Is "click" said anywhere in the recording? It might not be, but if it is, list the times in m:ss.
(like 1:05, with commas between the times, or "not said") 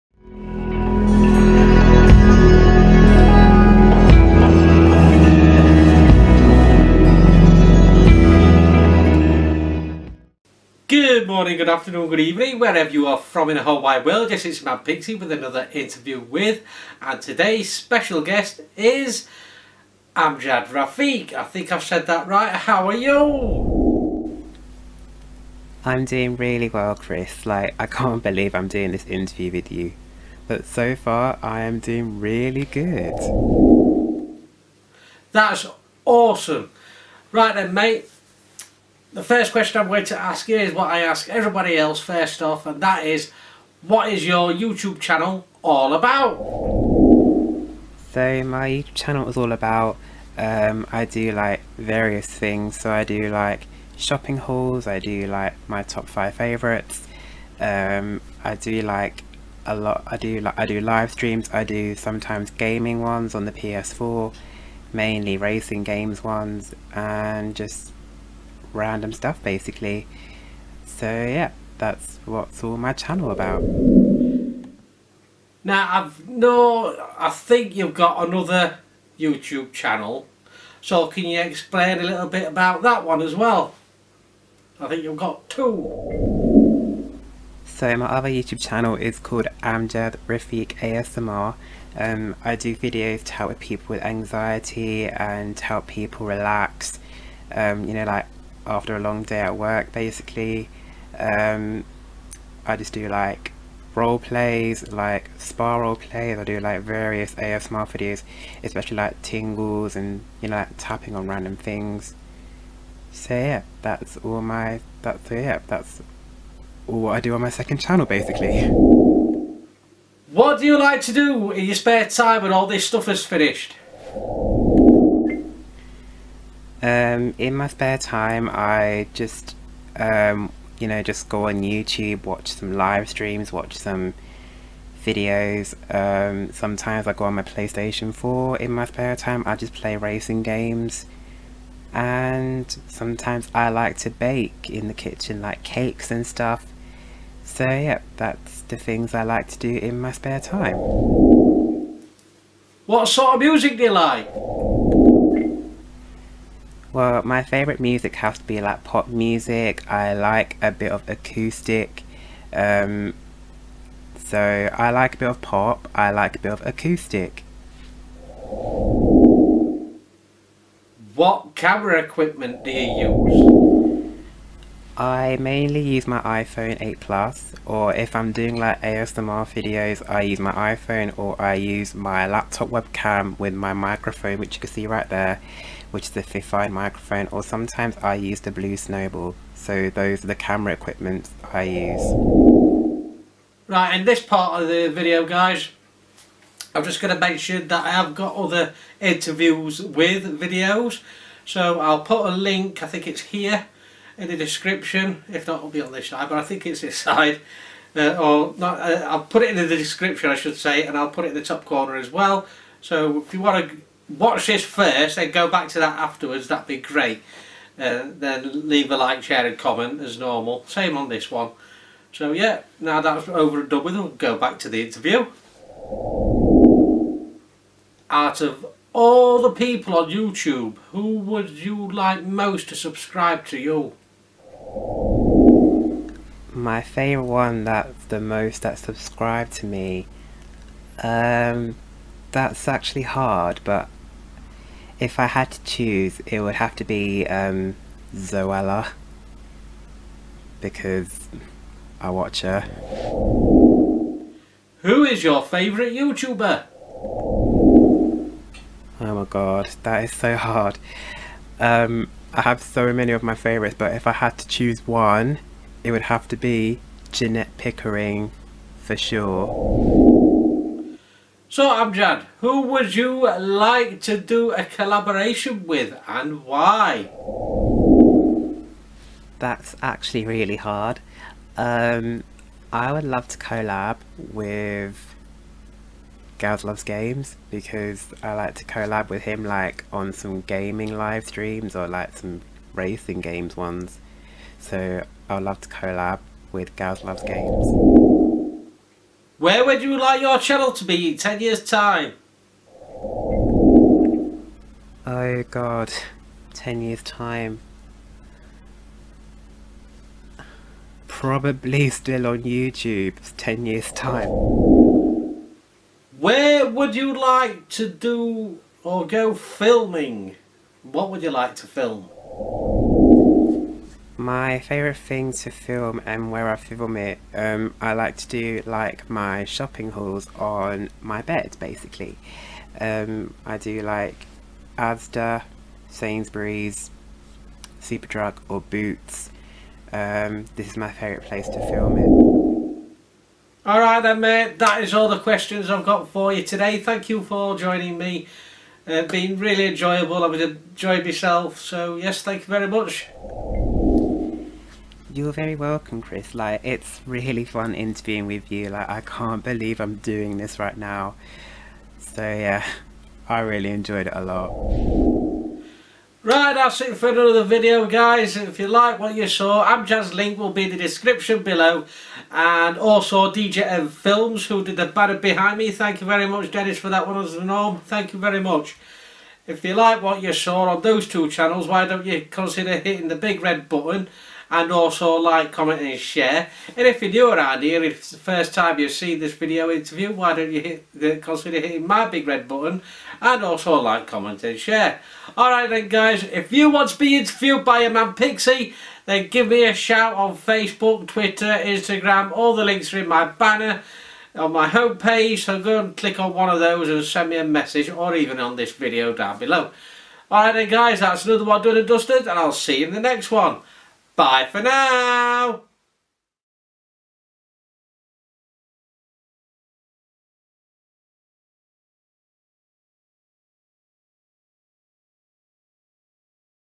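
6:45.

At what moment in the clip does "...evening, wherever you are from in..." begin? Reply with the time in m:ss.
0:12.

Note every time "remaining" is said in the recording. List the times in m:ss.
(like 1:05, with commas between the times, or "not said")
not said.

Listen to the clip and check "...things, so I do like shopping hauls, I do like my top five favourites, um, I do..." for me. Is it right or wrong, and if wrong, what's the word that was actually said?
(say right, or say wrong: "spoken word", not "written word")
right.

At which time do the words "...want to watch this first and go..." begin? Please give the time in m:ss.
3:33.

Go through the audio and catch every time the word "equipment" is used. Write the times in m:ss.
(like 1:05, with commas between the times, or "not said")
2:51, 3:10.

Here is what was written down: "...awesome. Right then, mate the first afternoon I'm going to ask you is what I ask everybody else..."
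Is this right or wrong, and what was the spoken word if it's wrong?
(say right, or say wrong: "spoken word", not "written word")
wrong: "question", not "afternoon".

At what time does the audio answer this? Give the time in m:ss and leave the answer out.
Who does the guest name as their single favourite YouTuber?
4:27.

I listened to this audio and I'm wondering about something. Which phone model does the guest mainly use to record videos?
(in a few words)
iPhone 8 Plus.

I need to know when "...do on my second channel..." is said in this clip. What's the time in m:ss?
1:57.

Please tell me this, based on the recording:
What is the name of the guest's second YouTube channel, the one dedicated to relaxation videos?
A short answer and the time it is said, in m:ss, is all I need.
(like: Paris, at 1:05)
Amjad Rafiq ASMR, at 1:29.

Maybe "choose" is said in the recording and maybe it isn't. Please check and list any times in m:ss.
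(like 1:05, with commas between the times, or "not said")
4:05, 4:24.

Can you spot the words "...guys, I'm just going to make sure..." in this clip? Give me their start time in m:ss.
3:15.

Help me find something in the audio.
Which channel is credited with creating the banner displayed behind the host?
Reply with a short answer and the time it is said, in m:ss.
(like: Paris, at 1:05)
DJM Films, at 6:13.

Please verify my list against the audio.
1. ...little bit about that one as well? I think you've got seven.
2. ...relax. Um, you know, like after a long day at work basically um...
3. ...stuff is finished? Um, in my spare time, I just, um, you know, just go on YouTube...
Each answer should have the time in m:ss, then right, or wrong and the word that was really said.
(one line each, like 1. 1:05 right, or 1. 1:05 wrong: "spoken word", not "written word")
1. 1:22 wrong: "two", not "seven"
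2. 1:36 right
3. 2:02 right.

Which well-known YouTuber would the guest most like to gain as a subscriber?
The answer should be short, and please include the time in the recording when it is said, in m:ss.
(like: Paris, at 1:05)
Zoella, at 4:08.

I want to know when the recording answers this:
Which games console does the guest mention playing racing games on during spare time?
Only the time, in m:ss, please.
1:03.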